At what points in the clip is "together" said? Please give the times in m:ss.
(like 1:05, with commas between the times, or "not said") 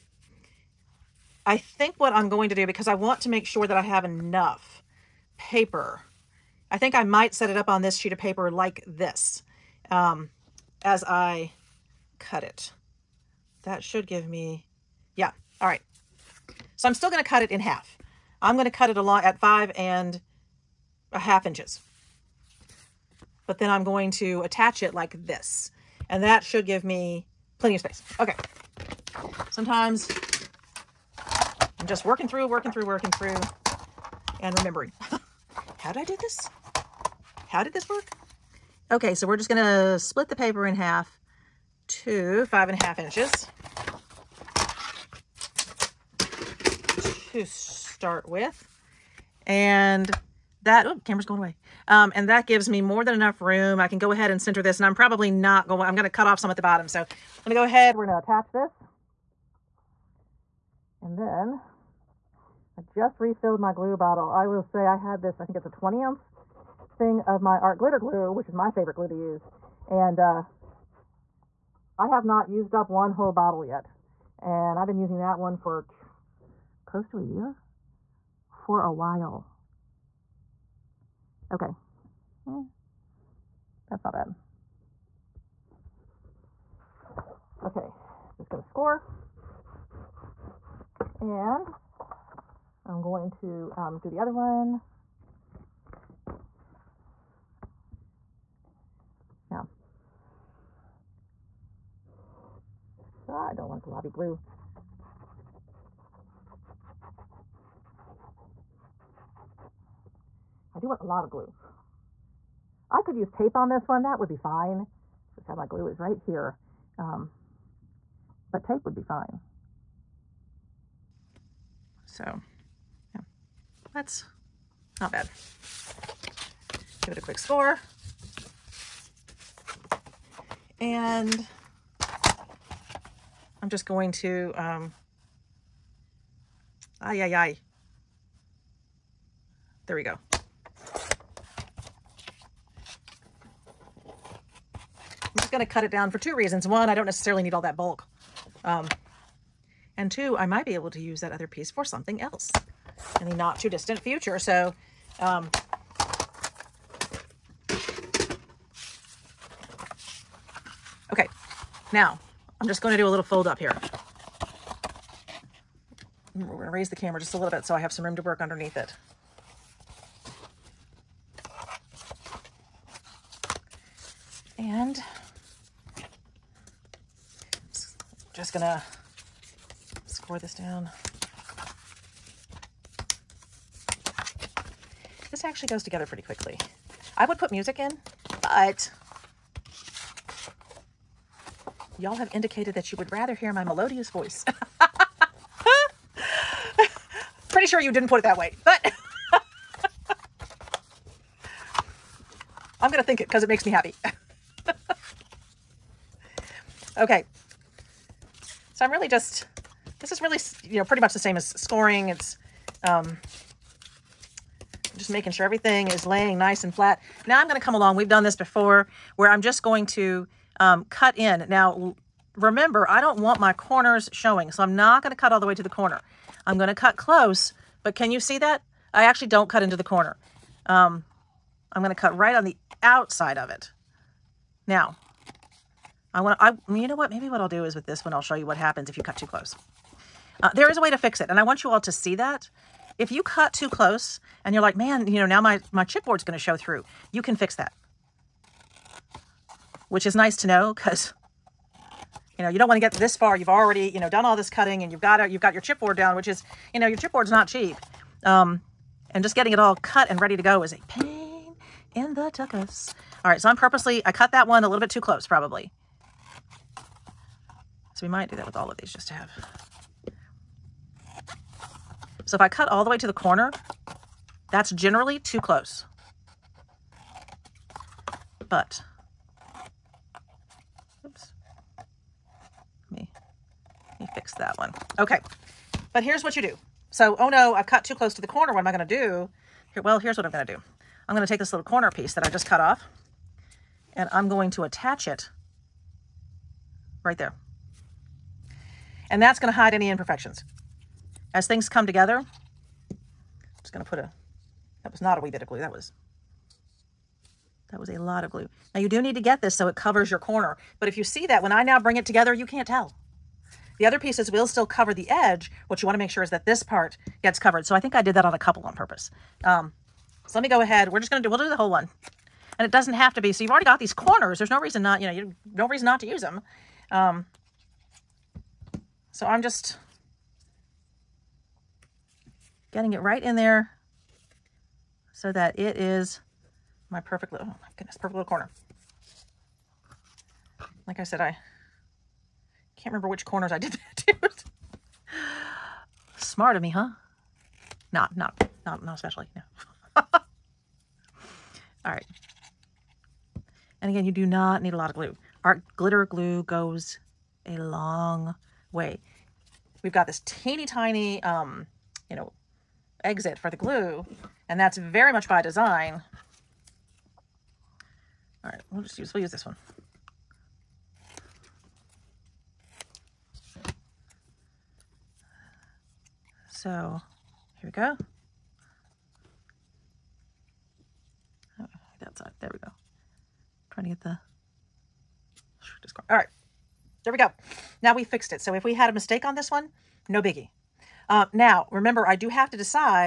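3:05, 5:01, 5:12.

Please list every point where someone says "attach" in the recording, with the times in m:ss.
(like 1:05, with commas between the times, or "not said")
0:24, 0:58, 4:54.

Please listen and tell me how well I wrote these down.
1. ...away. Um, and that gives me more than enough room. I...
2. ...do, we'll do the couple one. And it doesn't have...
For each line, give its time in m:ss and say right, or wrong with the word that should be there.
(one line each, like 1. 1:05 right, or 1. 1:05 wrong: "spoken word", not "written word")
1. 0:51 right
2. 5:21 wrong: "whole", not "couple".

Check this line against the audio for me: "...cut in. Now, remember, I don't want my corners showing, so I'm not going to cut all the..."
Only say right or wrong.
right.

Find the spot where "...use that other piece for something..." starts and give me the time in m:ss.
2:30.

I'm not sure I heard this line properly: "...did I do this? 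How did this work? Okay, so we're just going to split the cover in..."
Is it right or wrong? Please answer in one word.
wrong.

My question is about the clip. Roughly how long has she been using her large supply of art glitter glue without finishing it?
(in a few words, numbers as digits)
close to a year.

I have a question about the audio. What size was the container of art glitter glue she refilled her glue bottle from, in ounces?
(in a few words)
20.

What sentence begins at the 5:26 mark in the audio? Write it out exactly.
Um, so I'm just getting it right in there so that it is my perfect little, oh my goodness, perfect little corner.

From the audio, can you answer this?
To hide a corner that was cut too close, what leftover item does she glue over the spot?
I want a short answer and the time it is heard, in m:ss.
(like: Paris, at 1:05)
corner piece, at 4:51.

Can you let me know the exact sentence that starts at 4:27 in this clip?
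So we might do that with all of these just to have.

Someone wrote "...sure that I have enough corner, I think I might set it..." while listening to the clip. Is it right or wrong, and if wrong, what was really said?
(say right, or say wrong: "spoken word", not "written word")
wrong: "paper", not "corner".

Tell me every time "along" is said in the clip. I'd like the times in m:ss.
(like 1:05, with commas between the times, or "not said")
0:18, 3:37.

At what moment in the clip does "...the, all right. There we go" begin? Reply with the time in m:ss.
6:24.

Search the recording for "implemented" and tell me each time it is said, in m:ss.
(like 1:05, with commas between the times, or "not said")
not said.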